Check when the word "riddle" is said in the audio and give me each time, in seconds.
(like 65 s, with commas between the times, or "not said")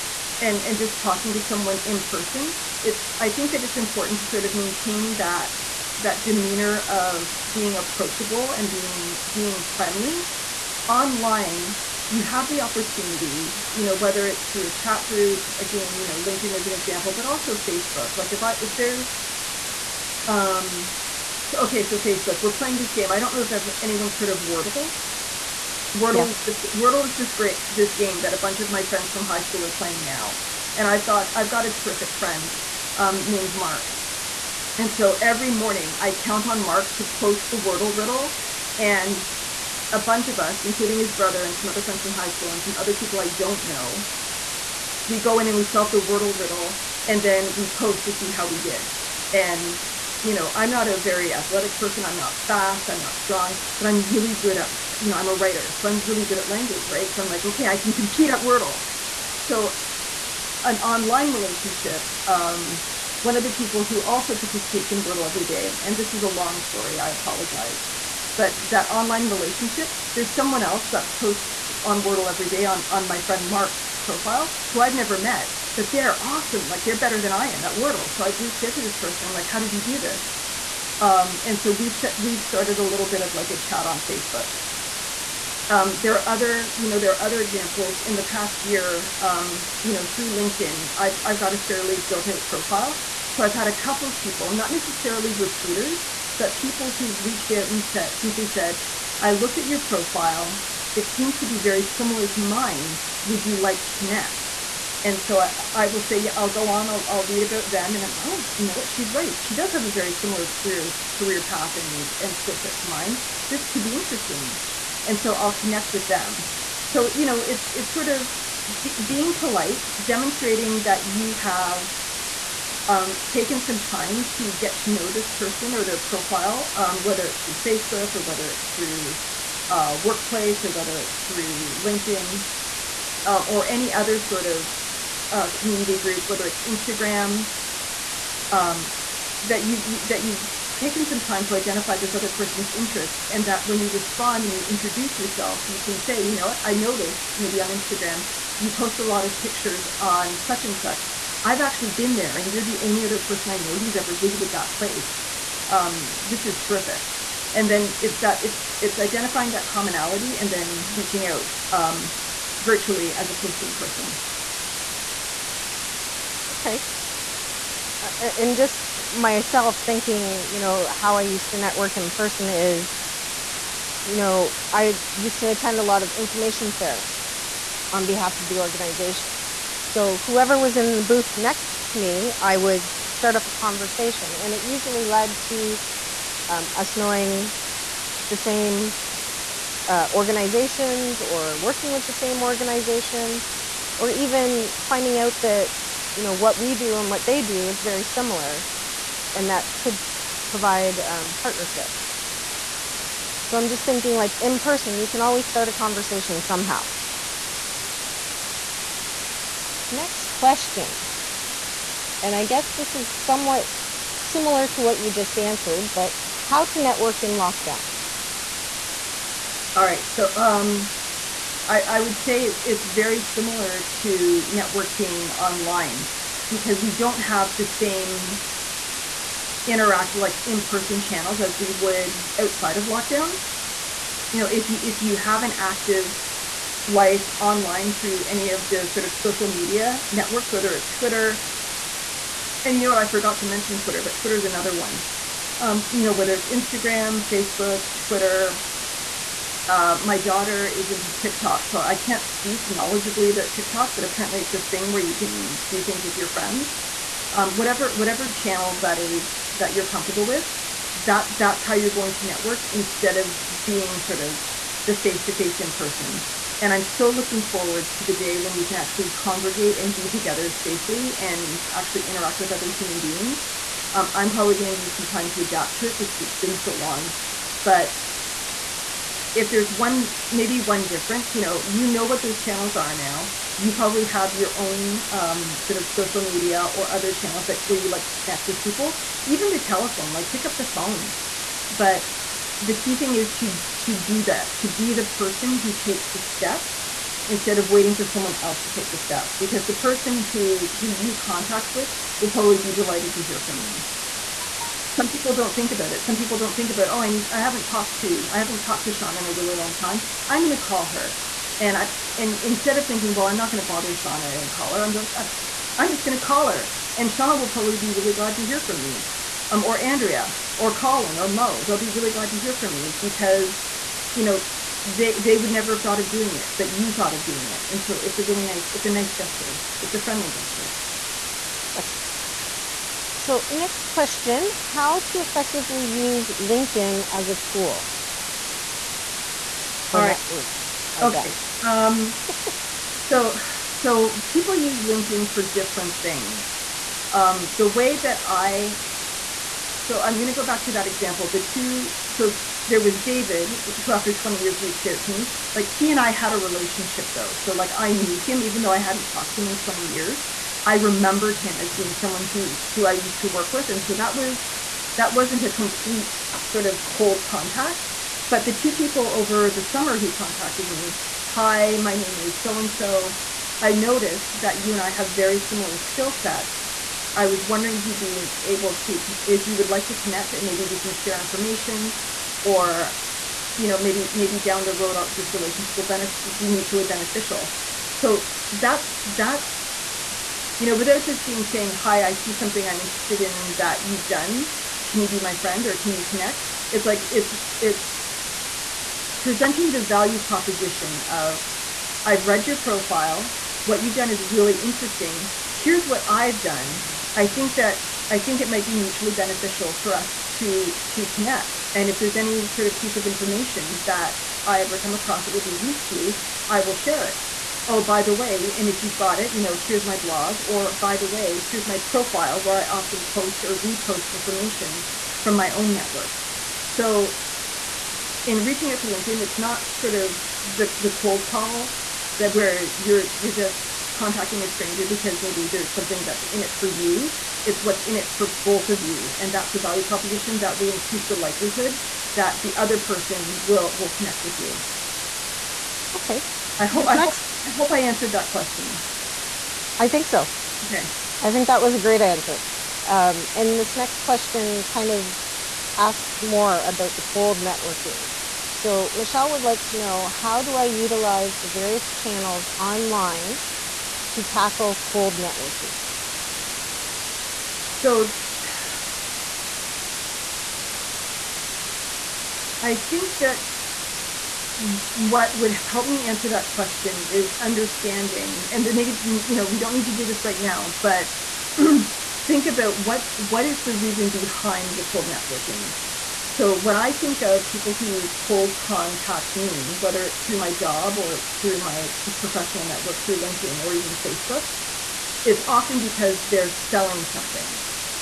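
37 s, 46 s.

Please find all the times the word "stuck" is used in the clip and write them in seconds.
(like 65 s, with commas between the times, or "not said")
not said.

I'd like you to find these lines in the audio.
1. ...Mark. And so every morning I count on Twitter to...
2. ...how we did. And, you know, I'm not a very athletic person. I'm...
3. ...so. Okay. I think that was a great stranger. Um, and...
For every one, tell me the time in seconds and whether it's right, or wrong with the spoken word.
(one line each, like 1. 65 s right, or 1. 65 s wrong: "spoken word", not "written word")
1. 33 s wrong: "Mark", not "Twitter"
2. 48 s right
3. 450 s wrong: "answer", not "stranger".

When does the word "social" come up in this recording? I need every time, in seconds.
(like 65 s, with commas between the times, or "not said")
239 s, 285 s.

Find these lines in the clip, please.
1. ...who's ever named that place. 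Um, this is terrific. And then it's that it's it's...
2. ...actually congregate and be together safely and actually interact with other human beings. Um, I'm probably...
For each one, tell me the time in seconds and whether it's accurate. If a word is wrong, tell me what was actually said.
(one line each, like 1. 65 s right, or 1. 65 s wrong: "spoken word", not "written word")
1. 153 s wrong: "visited", not "named"
2. 268 s right.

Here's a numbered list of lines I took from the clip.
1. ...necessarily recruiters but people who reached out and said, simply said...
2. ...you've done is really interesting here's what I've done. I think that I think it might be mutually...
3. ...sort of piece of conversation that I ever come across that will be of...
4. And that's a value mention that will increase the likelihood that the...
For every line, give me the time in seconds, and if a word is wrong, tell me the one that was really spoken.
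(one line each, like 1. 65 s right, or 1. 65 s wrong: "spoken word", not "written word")
1. 94 s right
2. 403 s right
3. 412 s wrong: "information", not "conversation"
4. 439 s wrong: "proposition", not "mention".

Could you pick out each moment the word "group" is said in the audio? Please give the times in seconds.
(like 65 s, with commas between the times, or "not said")
15 s, 135 s.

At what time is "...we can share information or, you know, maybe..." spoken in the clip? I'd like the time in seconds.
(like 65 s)
380 s.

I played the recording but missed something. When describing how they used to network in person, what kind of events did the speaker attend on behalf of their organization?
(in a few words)
information fairs.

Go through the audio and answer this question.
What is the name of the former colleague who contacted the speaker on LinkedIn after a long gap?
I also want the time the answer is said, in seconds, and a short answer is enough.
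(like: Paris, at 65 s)
David, at 352 s.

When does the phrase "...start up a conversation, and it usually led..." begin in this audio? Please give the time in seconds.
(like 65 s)
183 s.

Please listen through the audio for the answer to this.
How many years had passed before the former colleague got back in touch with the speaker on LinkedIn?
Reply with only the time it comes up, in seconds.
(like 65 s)
353 s.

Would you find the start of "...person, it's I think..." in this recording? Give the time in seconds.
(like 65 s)
2 s.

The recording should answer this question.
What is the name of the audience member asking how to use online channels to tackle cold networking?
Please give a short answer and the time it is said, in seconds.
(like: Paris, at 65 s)
Michelle, at 458 s.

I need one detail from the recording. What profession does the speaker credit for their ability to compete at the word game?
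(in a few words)
writer.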